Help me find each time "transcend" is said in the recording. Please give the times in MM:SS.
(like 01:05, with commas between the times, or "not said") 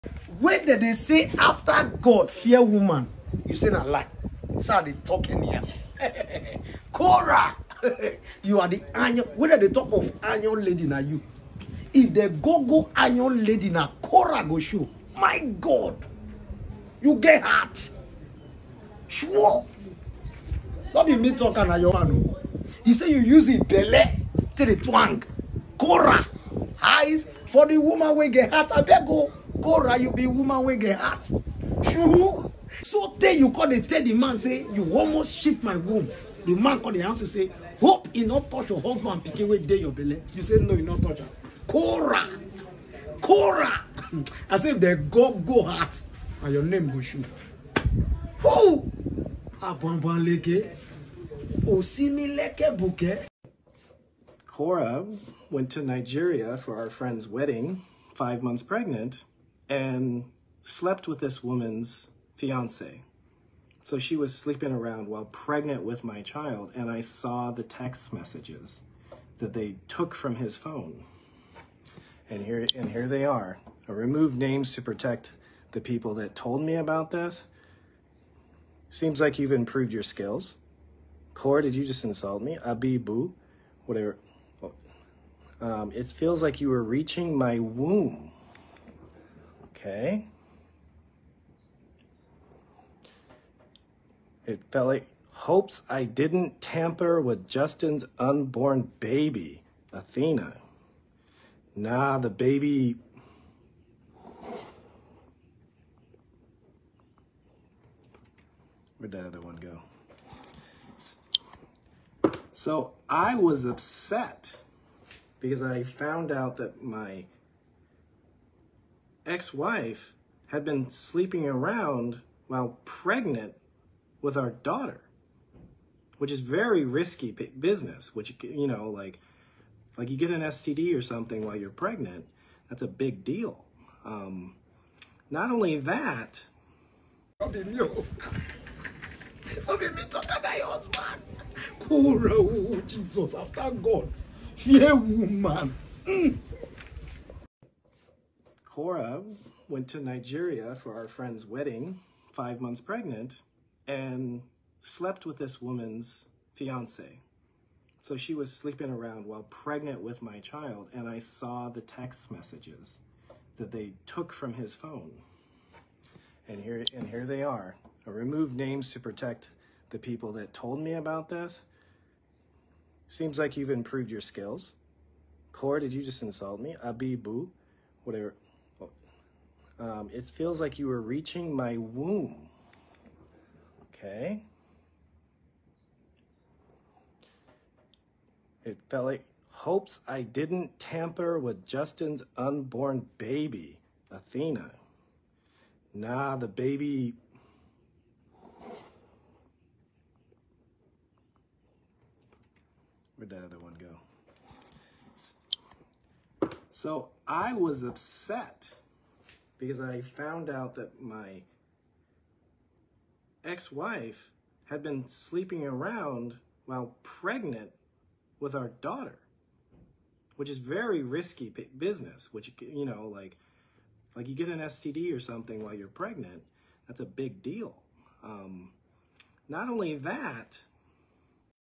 not said.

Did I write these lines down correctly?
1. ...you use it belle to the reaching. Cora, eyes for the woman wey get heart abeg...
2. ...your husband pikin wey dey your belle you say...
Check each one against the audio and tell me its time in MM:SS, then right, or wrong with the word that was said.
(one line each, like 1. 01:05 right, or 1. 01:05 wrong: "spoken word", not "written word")
1. 00:23 wrong: "twang", not "reaching"
2. 00:38 right.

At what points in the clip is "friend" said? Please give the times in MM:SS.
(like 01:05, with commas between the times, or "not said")
00:56, 02:31.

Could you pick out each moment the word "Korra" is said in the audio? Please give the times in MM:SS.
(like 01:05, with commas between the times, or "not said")
00:54, 02:28.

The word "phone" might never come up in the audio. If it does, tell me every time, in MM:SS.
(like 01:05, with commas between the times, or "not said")
01:10, 02:44.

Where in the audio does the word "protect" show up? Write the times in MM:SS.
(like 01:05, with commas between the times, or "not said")
01:14, 02:48.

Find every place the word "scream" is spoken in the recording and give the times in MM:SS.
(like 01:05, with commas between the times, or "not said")
not said.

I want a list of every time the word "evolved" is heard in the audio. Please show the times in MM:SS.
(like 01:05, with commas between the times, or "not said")
not said.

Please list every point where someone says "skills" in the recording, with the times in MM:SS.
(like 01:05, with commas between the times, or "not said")
01:20, 02:54.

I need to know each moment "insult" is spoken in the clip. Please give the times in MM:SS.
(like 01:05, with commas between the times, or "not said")
01:22, 02:56.